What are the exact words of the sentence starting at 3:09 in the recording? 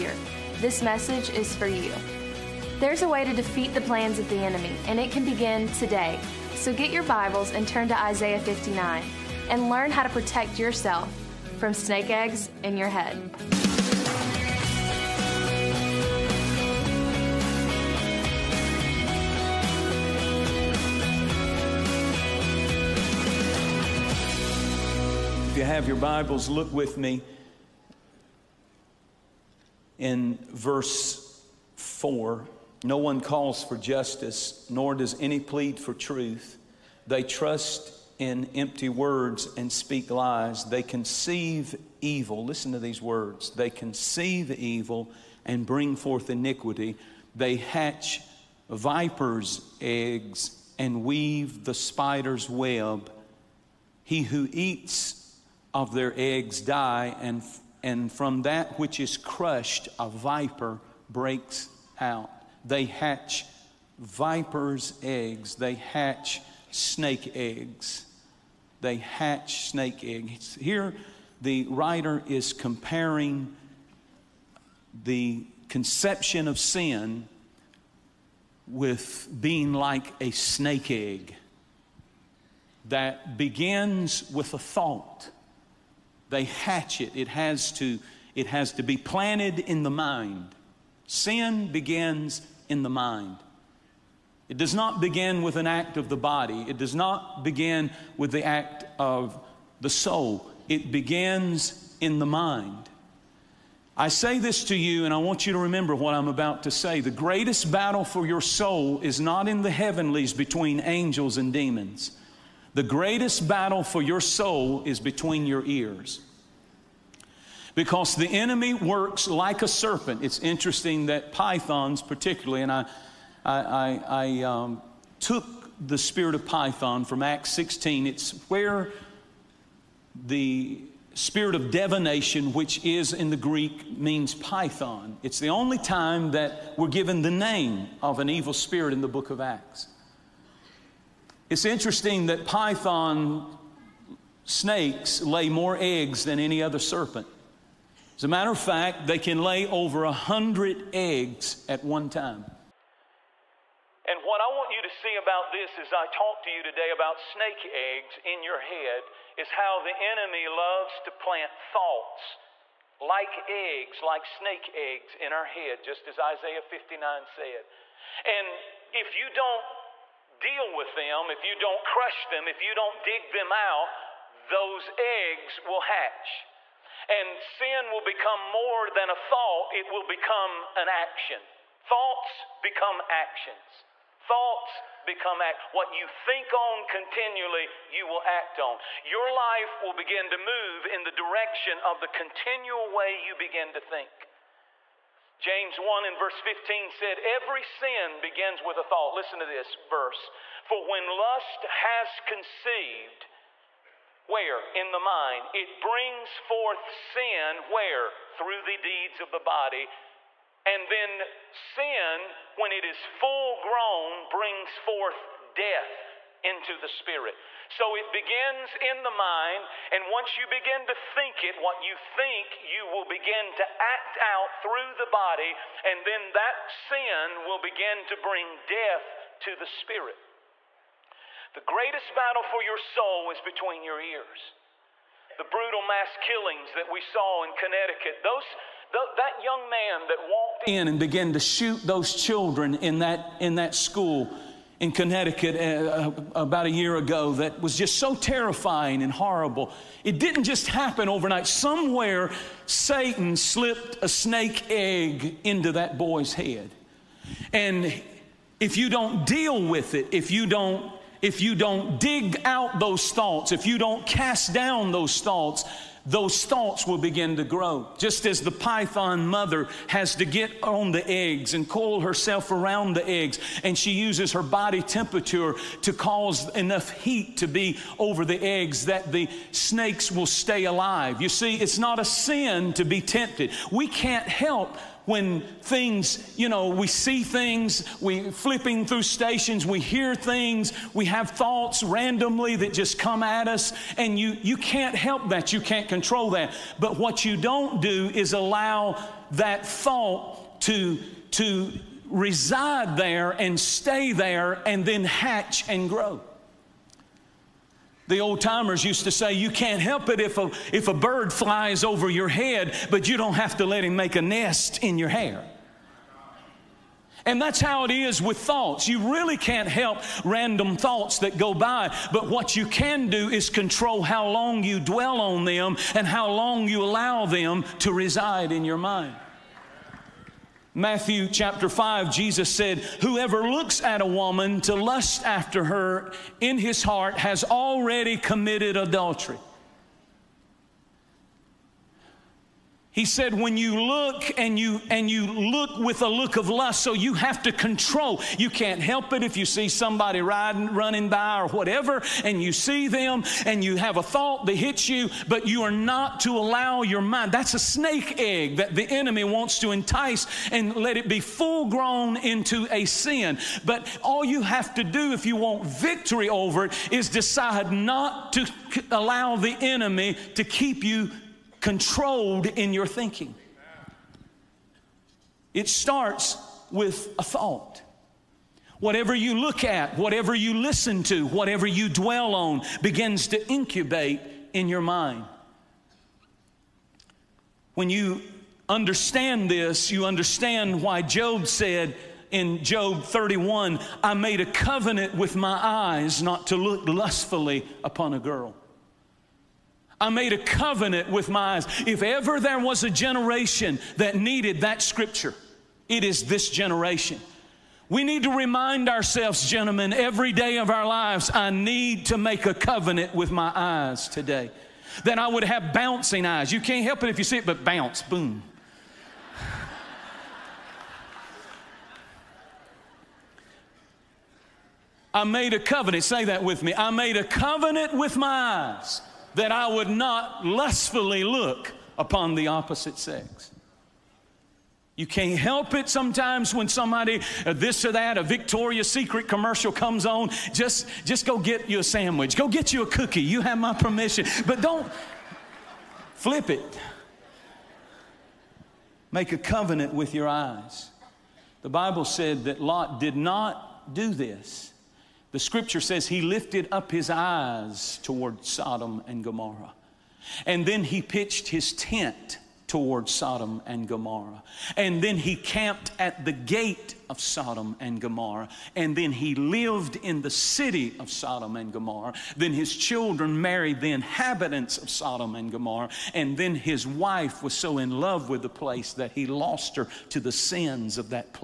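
Your life will begin to move in the direction of the continual way you begin to think.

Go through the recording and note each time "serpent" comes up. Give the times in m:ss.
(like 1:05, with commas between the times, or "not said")
1:59, 2:26.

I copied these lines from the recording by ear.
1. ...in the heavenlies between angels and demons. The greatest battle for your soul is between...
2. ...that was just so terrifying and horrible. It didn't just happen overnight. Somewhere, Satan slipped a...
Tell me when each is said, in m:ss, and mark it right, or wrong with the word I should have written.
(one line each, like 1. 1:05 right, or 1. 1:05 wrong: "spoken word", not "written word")
1. 1:49 right
2. 4:07 right.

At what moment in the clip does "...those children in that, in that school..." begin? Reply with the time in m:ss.
4:01.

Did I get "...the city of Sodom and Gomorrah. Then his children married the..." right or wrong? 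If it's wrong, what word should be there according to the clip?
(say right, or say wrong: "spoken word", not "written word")
right.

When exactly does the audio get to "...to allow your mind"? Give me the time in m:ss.
5:56.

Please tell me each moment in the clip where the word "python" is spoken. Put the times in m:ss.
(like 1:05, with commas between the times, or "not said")
2:01, 2:06, 2:14, 2:22, 4:28.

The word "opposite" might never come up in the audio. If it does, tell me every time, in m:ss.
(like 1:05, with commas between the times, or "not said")
7:12.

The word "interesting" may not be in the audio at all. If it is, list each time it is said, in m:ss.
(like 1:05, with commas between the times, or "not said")
2:00, 2:21.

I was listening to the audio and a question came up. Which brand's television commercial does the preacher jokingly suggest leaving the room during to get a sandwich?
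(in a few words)
Victoria's Secret.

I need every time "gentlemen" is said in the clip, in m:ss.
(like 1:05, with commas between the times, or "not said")
6:49.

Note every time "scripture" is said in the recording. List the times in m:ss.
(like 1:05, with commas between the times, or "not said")
6:44, 7:35.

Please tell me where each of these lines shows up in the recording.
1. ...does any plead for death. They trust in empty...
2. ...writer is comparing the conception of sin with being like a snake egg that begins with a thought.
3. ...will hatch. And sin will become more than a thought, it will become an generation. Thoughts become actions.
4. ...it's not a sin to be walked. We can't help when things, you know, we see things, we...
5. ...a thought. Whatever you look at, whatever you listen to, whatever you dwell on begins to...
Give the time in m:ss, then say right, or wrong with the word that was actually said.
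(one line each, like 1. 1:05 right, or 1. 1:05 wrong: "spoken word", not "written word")
1. 0:34 wrong: "truth", not "death"
2. 1:11 right
3. 2:55 wrong: "action", not "generation"
4. 4:41 wrong: "tempted", not "walked"
5. 6:17 right.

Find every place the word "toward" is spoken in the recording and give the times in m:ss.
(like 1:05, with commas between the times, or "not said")
7:38, 7:42.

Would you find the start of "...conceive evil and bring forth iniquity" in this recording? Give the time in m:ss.
0:43.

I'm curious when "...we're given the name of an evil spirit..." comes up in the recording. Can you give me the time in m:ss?
2:16.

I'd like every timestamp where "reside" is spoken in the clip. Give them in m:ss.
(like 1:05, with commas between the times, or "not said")
5:02, 5:27.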